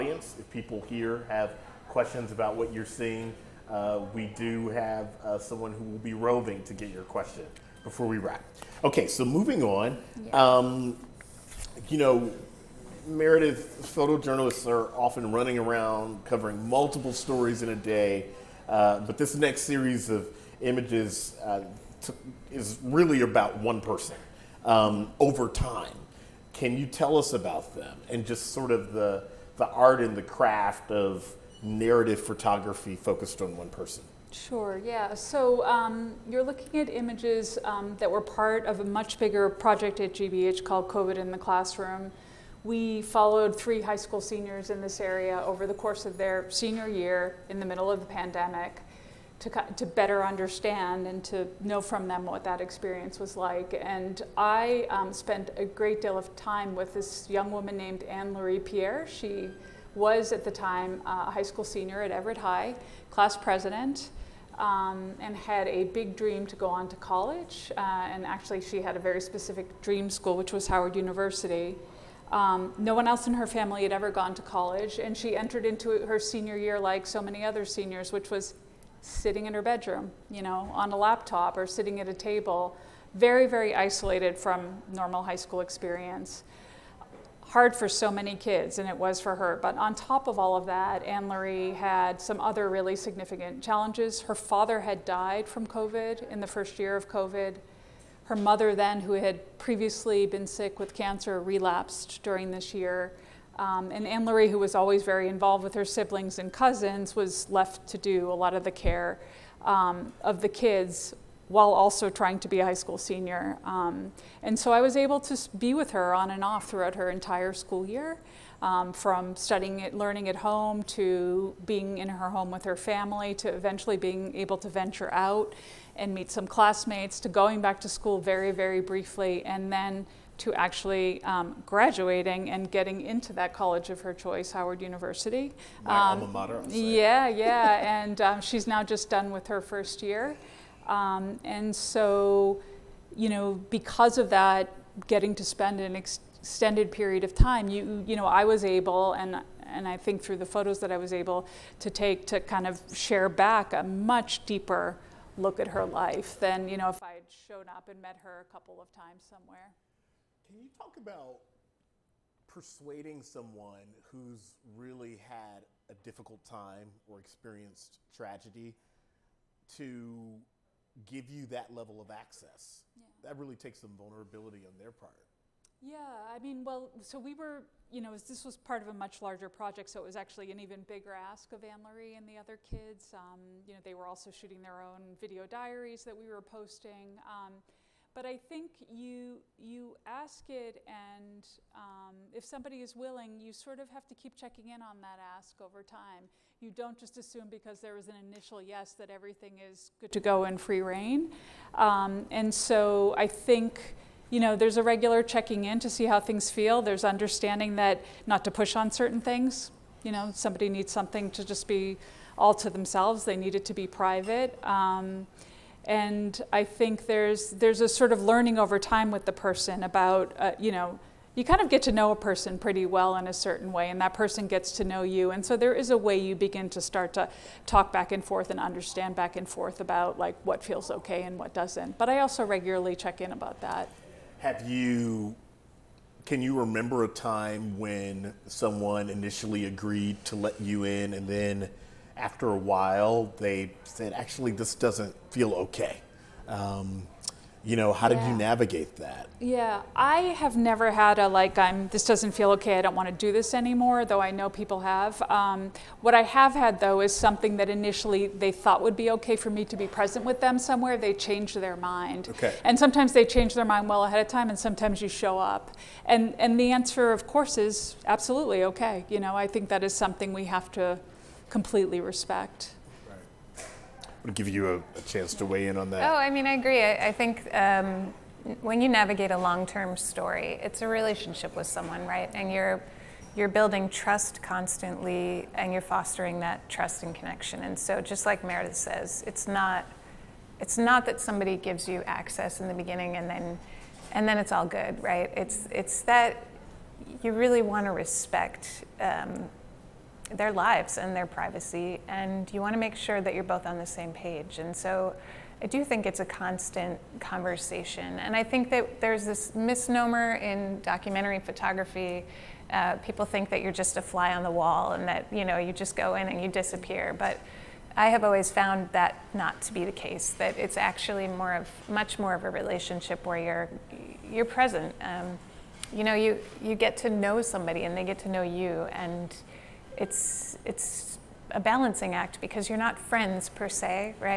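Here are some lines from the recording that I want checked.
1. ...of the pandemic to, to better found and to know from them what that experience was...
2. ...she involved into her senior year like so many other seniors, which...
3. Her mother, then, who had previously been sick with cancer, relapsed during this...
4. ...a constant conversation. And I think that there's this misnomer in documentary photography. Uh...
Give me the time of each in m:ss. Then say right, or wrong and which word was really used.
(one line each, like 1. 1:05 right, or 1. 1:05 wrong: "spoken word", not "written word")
1. 0:47 wrong: "understand", not "found"
2. 1:15 wrong: "entered", not "involved"
3. 1:38 right
4. 5:06 right.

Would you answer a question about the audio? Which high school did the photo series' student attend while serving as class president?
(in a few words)
Everett High.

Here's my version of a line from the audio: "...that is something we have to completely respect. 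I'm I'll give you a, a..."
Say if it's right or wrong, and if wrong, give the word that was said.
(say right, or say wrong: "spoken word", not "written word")
right.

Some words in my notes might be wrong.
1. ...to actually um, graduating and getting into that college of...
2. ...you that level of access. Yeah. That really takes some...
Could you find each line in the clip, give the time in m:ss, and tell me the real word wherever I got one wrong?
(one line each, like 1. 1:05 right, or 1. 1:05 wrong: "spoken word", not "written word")
1. 2:10 right
2. 2:51 right.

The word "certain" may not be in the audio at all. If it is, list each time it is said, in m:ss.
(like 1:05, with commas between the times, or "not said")
3:28, 3:43.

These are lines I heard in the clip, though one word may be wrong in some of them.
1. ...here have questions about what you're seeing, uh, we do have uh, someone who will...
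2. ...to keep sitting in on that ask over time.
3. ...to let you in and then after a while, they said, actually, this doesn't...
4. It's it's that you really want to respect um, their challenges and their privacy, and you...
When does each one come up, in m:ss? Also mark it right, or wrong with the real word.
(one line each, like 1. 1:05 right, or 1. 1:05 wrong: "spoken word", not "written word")
1. 0:00 right
2. 3:14 wrong: "checking", not "sitting"
3. 4:00 right
4. 4:55 wrong: "lives", not "challenges".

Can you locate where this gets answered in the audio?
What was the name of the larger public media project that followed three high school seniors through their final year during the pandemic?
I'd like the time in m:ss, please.
0:40.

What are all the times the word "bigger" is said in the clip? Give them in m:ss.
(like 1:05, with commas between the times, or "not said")
0:39, 3:00.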